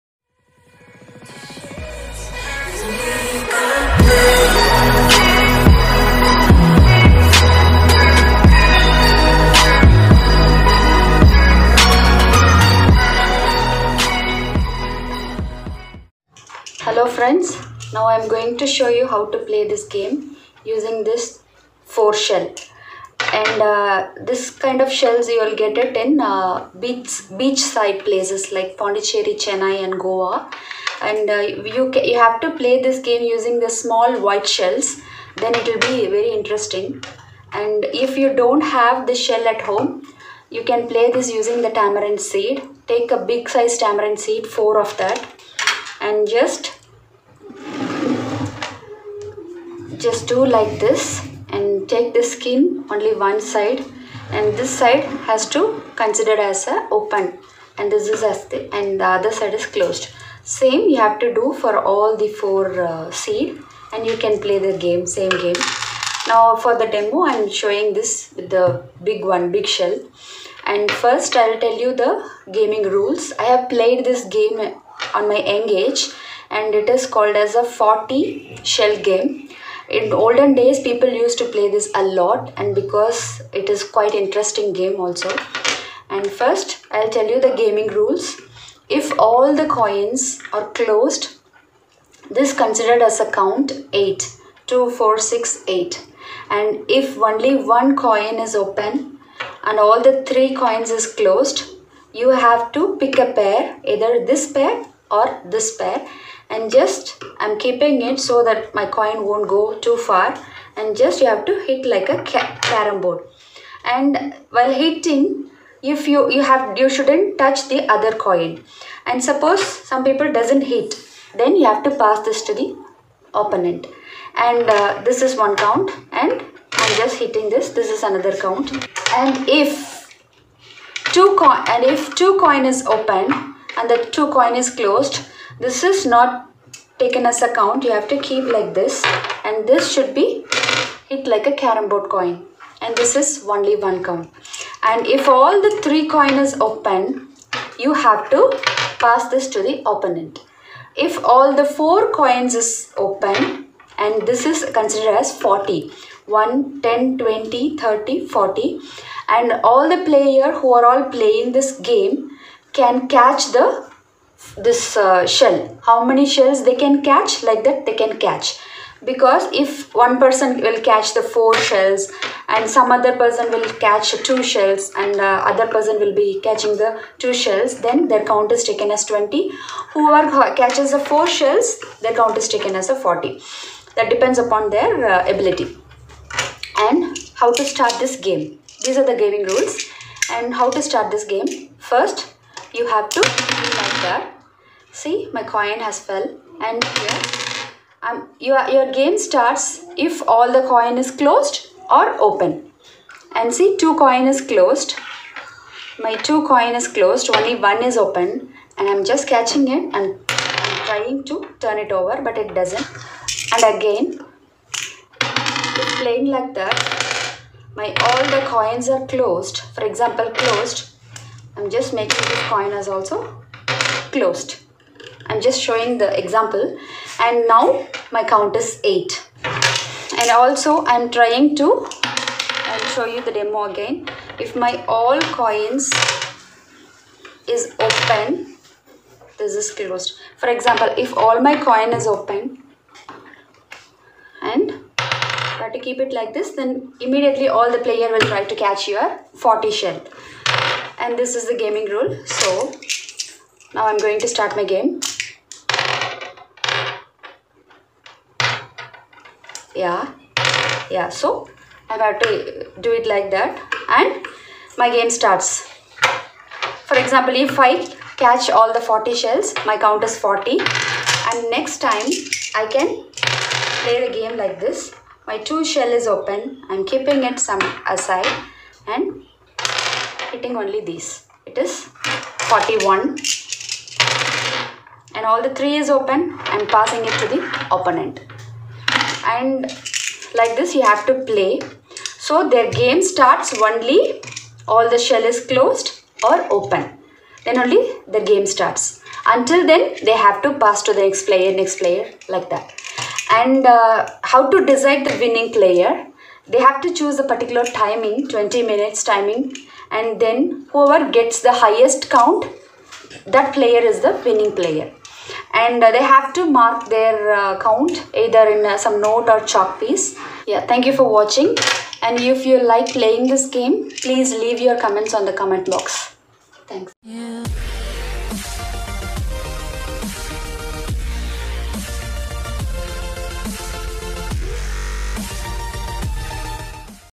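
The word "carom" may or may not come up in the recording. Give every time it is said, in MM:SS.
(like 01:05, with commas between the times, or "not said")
01:52, 02:21.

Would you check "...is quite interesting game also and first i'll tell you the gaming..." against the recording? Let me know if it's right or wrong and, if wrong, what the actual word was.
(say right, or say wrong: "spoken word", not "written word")
right.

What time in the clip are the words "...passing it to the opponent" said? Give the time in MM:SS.
04:46.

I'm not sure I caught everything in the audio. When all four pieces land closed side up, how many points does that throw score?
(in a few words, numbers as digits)
8.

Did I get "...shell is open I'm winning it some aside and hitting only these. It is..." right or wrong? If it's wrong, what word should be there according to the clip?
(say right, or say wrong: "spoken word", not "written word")
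wrong: "keeping", not "winning".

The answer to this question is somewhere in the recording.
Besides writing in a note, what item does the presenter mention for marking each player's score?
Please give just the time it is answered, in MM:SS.
05:19.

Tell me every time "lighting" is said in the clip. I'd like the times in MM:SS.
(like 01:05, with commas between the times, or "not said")
not said.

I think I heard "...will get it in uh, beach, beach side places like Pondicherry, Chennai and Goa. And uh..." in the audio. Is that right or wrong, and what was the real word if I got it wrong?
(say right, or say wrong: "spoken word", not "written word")
right.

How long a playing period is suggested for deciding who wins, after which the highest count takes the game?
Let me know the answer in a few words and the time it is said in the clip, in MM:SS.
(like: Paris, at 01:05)
20 minutes, at 05:08.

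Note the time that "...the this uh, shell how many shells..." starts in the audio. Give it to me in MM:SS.
02:43.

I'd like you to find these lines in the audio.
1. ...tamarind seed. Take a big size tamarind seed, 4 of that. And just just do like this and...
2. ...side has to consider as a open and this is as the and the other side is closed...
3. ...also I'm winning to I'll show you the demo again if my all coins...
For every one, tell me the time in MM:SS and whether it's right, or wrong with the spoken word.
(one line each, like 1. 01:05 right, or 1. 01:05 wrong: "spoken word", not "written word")
1. 00:41 right
2. 00:54 right
3. 03:50 wrong: "trying", not "winning".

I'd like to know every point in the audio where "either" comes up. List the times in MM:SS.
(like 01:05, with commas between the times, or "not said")
01:43, 05:18.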